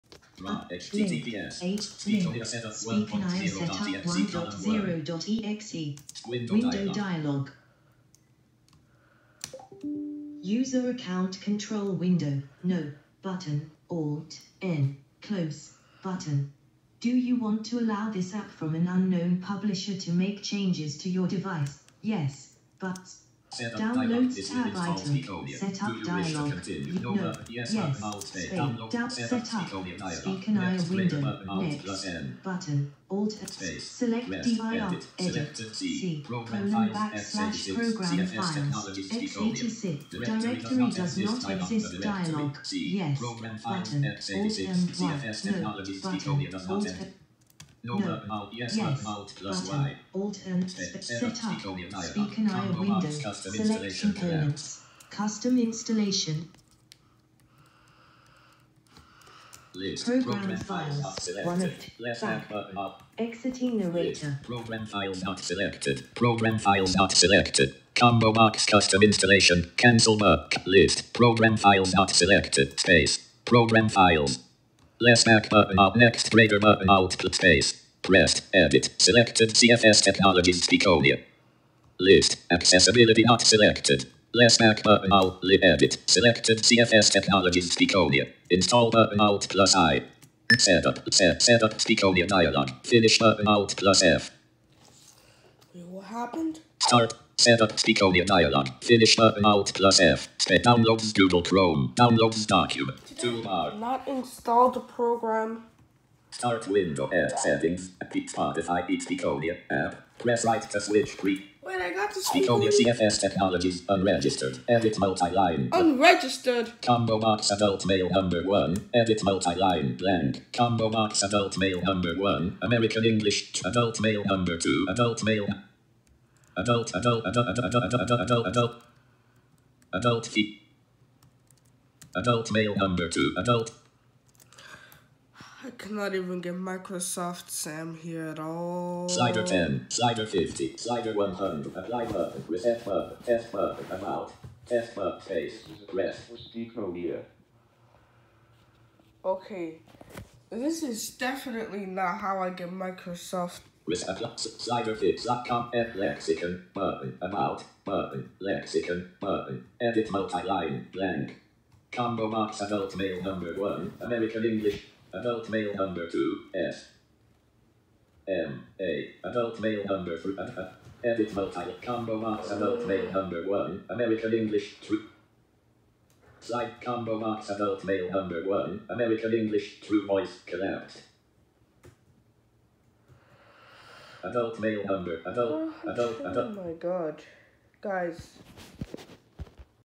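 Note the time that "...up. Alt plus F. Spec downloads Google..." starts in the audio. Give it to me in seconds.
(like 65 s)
99 s.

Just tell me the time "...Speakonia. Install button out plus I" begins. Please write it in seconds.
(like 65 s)
87 s.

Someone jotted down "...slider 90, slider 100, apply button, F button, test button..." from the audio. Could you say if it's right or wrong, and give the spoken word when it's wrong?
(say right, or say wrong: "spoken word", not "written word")
wrong: "50", not "90".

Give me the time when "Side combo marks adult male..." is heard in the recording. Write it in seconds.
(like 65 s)
176 s.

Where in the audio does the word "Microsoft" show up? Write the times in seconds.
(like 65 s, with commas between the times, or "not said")
136 s, 152 s.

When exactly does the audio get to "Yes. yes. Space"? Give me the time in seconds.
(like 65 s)
27 s.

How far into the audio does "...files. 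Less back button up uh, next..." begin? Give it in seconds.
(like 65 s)
73 s.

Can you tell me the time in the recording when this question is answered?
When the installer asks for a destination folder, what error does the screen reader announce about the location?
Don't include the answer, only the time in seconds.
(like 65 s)
40 s.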